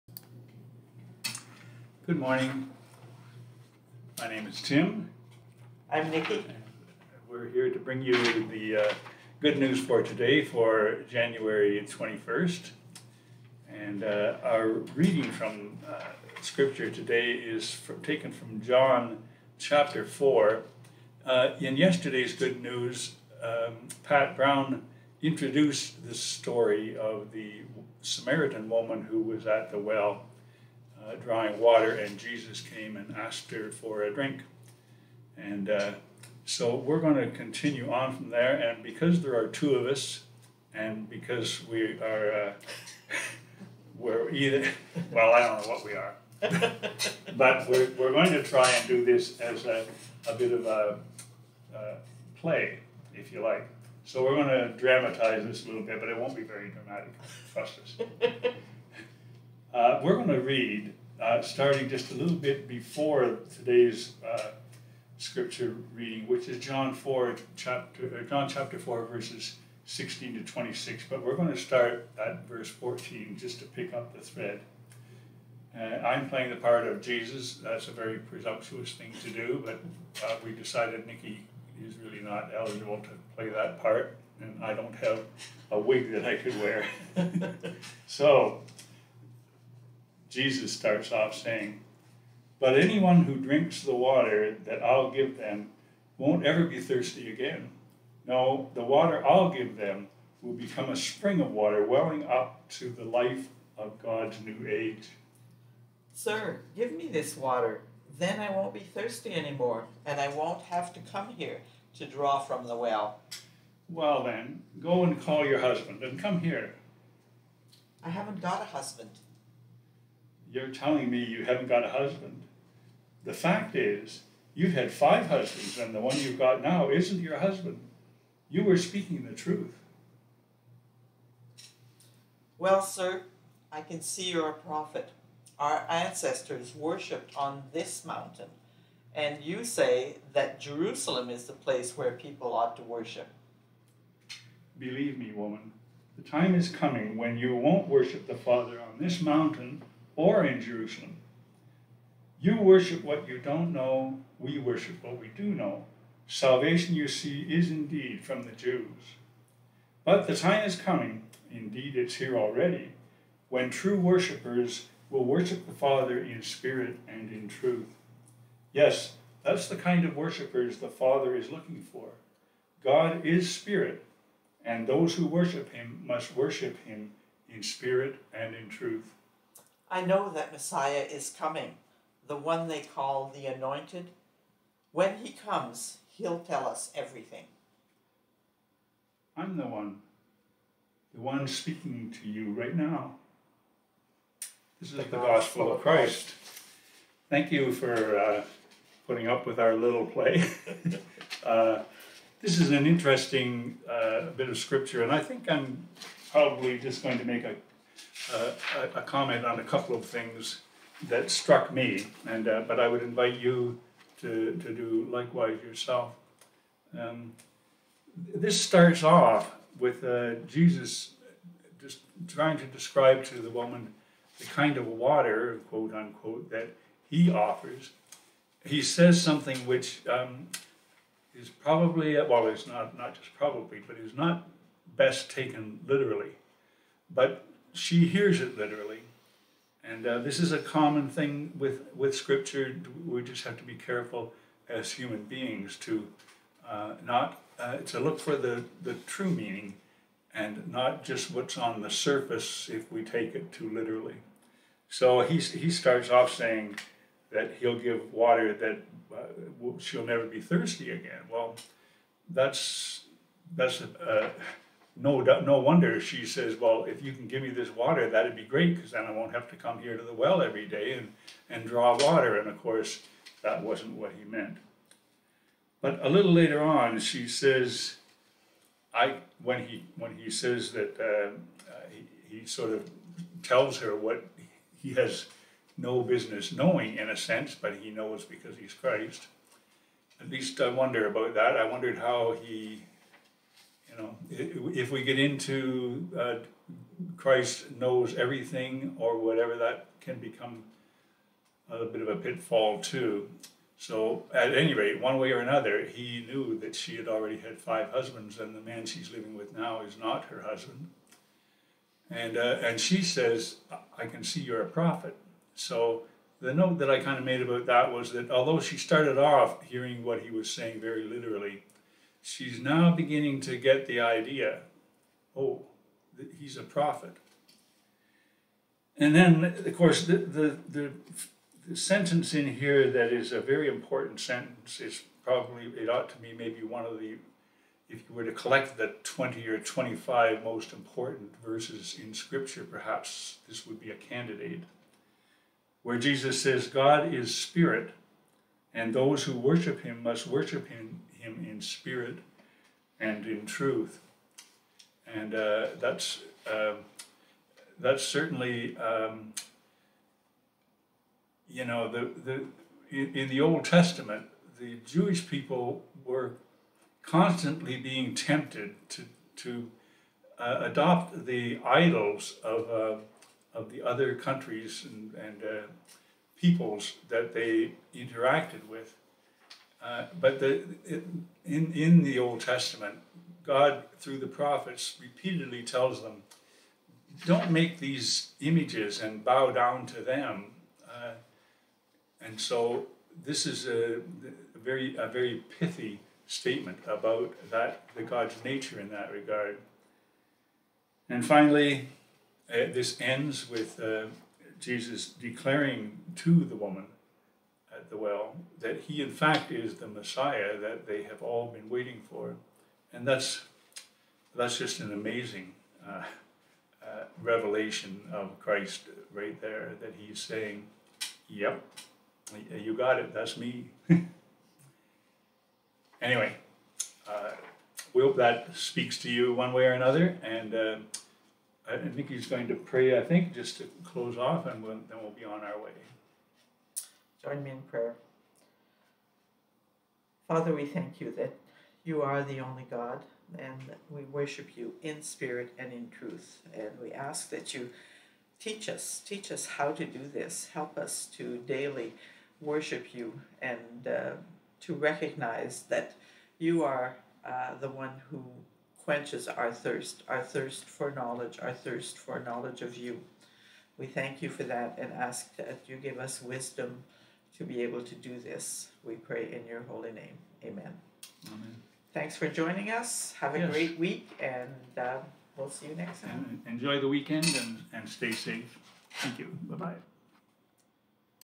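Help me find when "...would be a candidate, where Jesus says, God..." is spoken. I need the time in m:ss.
5:43.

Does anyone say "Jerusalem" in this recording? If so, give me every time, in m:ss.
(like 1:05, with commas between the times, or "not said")
2:20, 2:30.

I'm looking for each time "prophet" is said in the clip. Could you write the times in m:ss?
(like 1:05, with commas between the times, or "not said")
2:14, 5:14, 5:26, 6:24.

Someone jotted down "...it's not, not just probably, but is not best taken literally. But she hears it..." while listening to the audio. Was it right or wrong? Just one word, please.
right.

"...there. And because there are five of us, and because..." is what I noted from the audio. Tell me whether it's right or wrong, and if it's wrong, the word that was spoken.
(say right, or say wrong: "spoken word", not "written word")
wrong: "two", not "five".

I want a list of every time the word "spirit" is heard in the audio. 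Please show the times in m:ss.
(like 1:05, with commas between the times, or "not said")
2:46, 2:53, 2:57, 5:47, 5:51, 7:25.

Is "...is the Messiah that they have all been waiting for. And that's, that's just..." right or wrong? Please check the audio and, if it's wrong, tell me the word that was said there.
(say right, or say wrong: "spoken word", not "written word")
right.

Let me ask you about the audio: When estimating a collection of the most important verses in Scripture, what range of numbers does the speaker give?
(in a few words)
20 or 25.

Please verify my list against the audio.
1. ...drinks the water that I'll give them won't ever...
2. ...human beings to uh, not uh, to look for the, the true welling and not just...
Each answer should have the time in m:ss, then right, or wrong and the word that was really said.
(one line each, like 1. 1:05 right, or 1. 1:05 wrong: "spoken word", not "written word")
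1. 1:33 right
2. 4:04 wrong: "meaning", not "welling".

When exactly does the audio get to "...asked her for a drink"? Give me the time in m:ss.
0:33.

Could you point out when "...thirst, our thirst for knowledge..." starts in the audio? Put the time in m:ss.
7:39.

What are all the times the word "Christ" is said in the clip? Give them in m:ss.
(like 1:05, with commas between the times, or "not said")
3:15, 4:48, 4:57, 6:58.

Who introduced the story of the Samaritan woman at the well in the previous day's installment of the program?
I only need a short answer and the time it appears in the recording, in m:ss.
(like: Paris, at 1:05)
Pat Brown, at 0:24.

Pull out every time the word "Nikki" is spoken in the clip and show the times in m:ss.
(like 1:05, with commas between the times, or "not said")
0:06, 1:21.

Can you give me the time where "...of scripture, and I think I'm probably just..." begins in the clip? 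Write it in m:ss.
3:24.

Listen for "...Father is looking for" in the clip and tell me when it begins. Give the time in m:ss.
2:50.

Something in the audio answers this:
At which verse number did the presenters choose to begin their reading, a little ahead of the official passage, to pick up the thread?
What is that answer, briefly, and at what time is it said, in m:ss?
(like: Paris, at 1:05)
14, at 1:12.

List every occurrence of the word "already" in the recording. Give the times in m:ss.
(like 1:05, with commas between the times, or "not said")
2:42, 5:07.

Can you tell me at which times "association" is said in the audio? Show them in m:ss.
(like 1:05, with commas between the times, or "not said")
not said.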